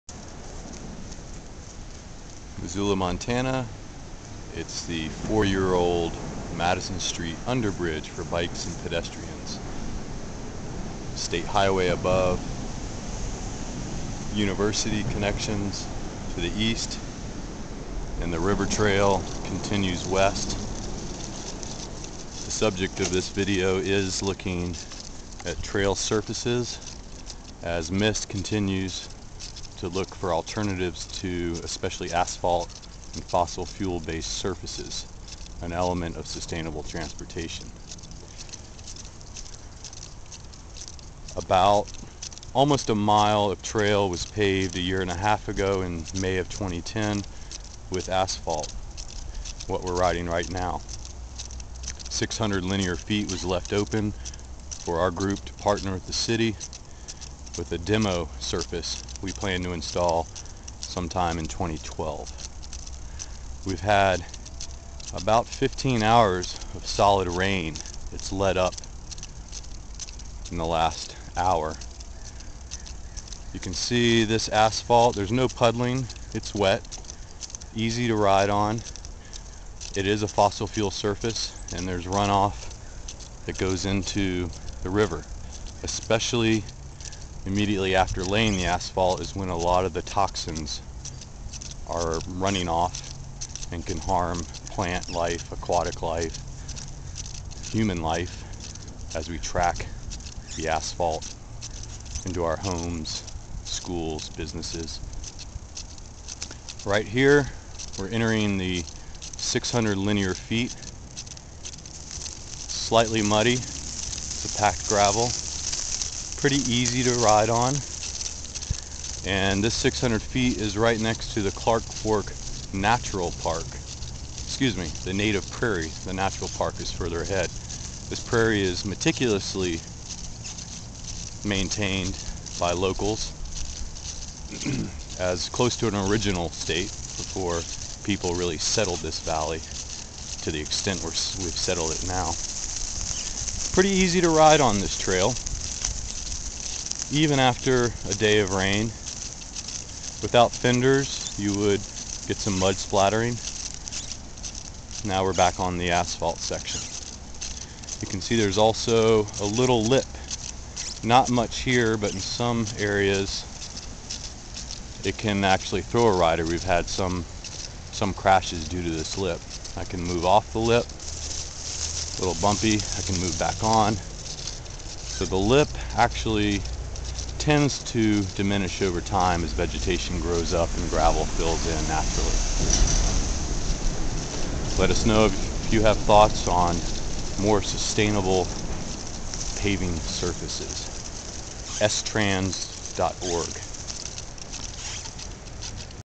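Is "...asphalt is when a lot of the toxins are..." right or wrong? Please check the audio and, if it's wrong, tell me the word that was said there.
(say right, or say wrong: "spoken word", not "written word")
right.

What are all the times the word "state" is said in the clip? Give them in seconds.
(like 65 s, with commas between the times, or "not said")
11 s, 136 s.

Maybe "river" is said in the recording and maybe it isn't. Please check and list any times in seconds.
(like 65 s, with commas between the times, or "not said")
18 s, 84 s.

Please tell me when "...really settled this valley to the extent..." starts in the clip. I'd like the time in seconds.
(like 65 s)
138 s.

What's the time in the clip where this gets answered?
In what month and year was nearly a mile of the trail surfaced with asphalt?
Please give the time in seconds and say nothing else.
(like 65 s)
46 s.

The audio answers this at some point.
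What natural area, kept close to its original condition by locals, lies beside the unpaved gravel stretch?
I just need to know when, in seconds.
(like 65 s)
125 s.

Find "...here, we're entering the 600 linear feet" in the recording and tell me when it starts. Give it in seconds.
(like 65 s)
107 s.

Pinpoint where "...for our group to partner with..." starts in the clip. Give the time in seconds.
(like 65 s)
54 s.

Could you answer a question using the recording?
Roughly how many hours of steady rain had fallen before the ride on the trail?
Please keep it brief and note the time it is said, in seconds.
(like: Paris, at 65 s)
15 hours, at 65 s.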